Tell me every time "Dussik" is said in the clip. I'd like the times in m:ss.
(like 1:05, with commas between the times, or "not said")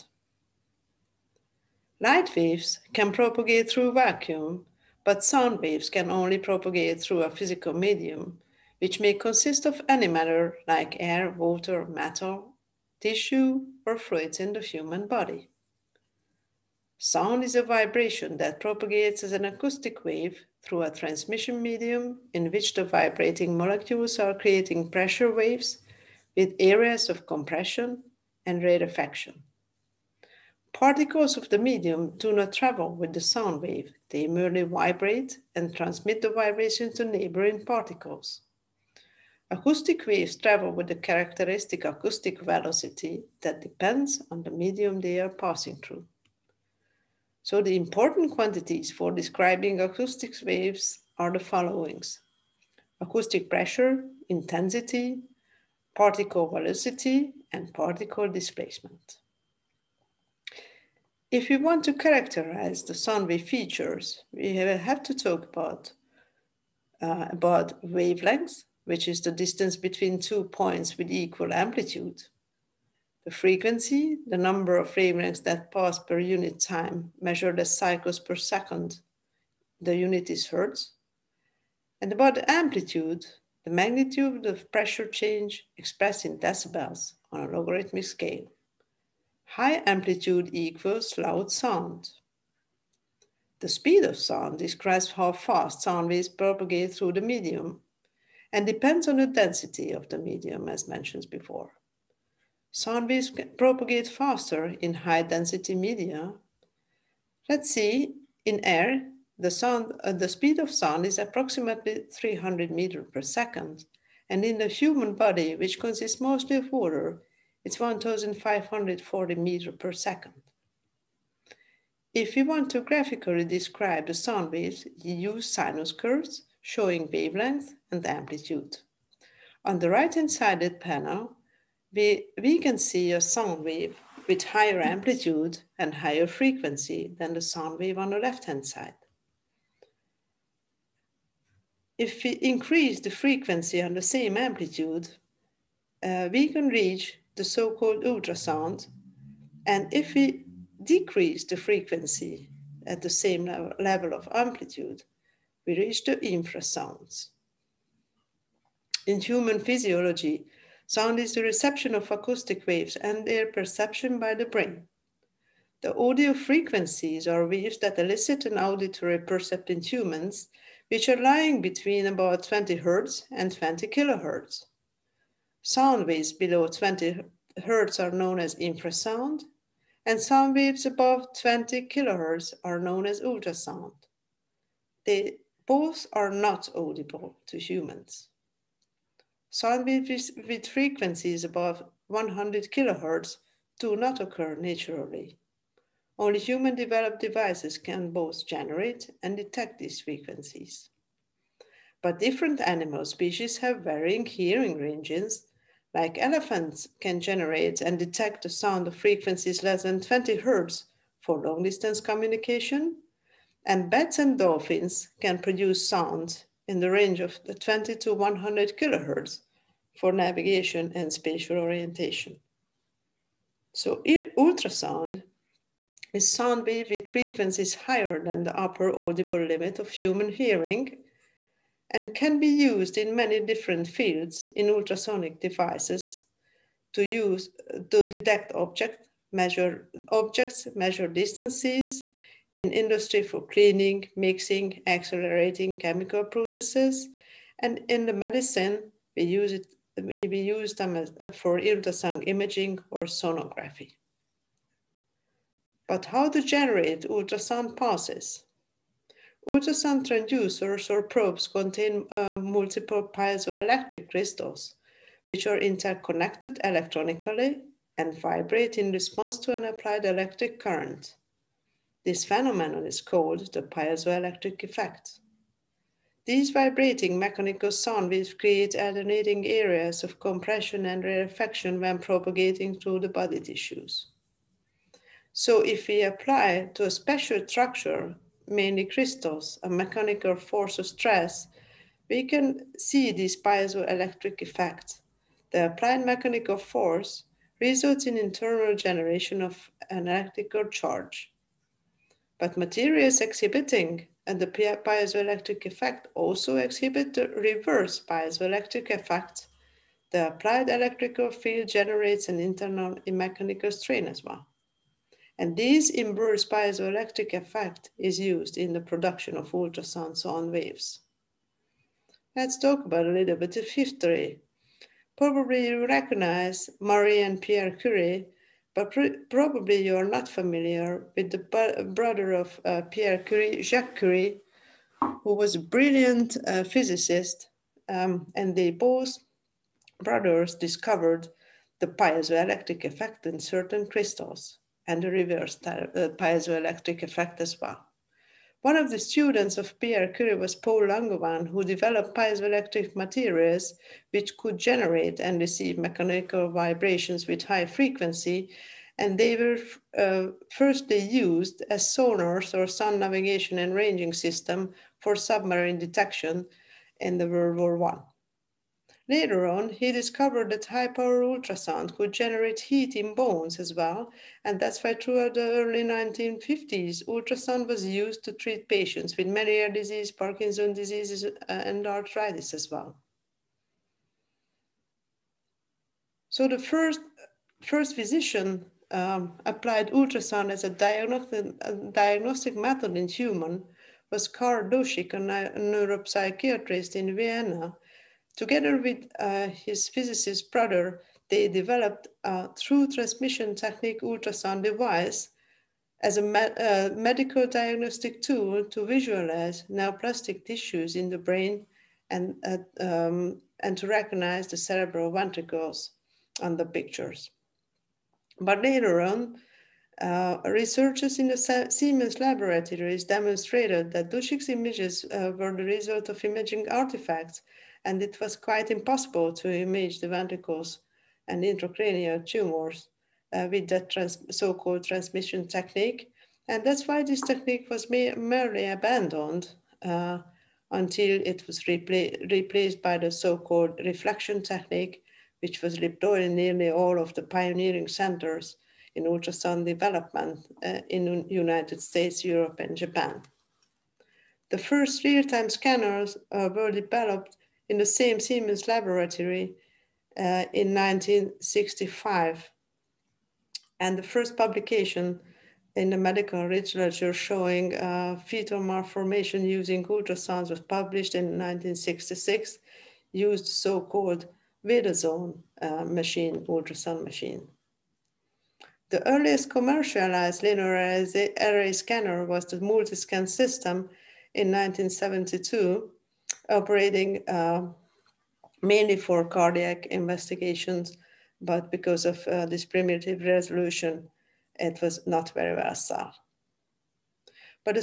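6:34, 7:04.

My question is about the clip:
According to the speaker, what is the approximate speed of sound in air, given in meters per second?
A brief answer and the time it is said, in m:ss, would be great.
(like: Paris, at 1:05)
300, at 1:52.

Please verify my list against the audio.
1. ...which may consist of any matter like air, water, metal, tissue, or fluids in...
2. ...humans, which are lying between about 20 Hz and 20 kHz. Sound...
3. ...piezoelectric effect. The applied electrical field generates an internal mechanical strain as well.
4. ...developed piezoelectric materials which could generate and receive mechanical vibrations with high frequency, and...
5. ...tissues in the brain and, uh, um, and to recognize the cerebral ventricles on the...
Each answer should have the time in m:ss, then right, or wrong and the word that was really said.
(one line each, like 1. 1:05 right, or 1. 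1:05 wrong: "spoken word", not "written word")
1. 0:08 right
2. 2:49 right
3. 5:08 right
4. 5:51 right
5. 6:50 right.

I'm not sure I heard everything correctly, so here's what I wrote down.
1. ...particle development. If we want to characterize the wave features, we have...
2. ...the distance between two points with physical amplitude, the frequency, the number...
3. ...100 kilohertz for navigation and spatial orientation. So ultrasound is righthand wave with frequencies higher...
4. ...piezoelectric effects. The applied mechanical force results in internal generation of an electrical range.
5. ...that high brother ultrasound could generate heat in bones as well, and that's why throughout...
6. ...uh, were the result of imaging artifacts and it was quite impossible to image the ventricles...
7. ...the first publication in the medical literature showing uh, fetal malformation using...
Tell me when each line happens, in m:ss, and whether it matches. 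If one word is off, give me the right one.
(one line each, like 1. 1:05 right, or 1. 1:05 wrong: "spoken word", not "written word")
1. 0:57 wrong: "displacement", not "development"
2. 1:09 wrong: "equal", not "physical"
3. 3:38 wrong: "sound", not "righthand"
4. 4:53 wrong: "charge", not "range"
5. 6:10 wrong: "power", not "brother"
6. 7:05 right
7. 7:43 right.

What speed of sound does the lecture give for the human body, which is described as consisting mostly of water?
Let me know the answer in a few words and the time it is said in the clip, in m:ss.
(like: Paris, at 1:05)
1,540 meters per second, at 1:57.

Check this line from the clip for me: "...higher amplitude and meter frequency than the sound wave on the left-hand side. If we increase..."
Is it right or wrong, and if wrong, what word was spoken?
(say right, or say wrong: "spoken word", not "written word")
wrong: "higher", not "meter".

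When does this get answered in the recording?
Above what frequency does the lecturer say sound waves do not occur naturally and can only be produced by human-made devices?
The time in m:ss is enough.
3:12.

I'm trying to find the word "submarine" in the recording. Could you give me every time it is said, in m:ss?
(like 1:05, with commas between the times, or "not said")
6:05.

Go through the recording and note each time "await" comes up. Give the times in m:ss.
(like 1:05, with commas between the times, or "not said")
not said.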